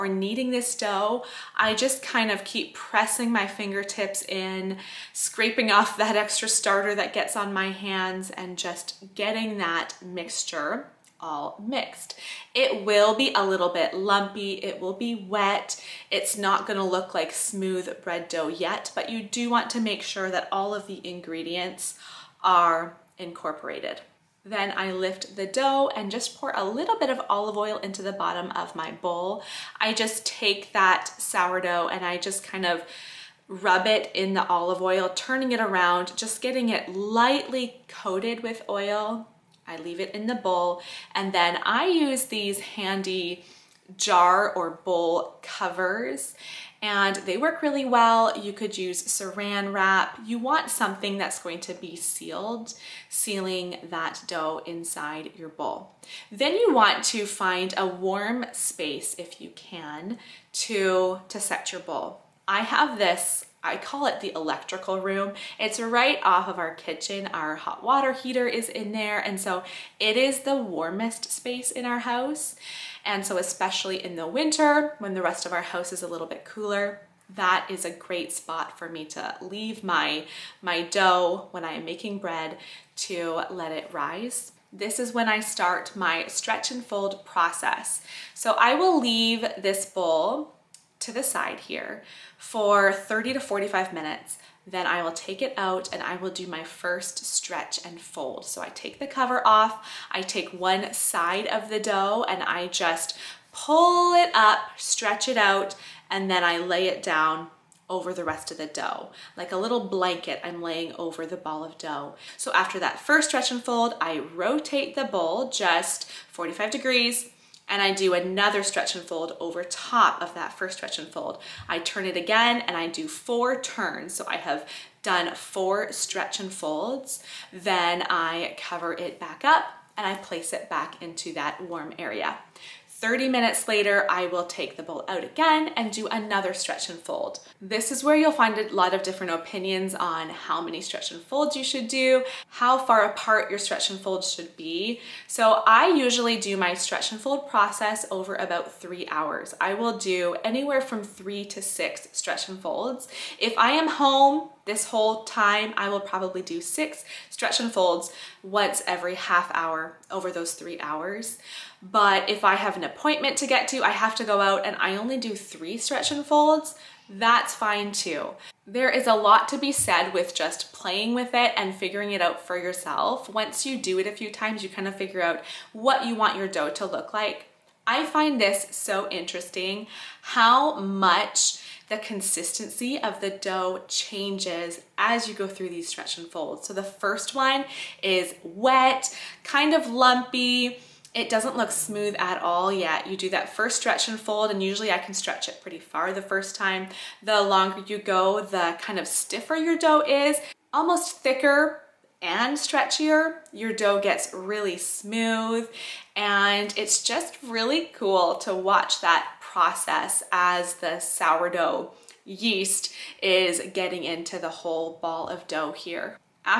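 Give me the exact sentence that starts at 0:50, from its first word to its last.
You want something that's going to be sealed, sealing that dough inside your bowl.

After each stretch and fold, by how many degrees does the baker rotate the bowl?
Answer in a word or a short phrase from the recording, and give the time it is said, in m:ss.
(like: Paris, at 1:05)
45 degrees, at 1:56.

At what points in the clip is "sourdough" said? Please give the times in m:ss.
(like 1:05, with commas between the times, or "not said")
0:31, 3:31.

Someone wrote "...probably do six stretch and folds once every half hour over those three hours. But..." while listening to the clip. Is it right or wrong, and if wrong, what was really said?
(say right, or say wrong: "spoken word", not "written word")
right.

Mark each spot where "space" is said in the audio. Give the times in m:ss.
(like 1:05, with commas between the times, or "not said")
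0:58, 1:11.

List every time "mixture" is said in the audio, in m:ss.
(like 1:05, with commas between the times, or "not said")
0:10.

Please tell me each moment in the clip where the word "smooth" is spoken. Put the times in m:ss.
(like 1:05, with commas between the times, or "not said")
0:17, 3:11, 3:24.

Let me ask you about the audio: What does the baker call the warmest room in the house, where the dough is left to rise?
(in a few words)
the electrical room.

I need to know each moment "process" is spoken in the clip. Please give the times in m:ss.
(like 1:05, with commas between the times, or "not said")
1:27, 2:27, 3:29.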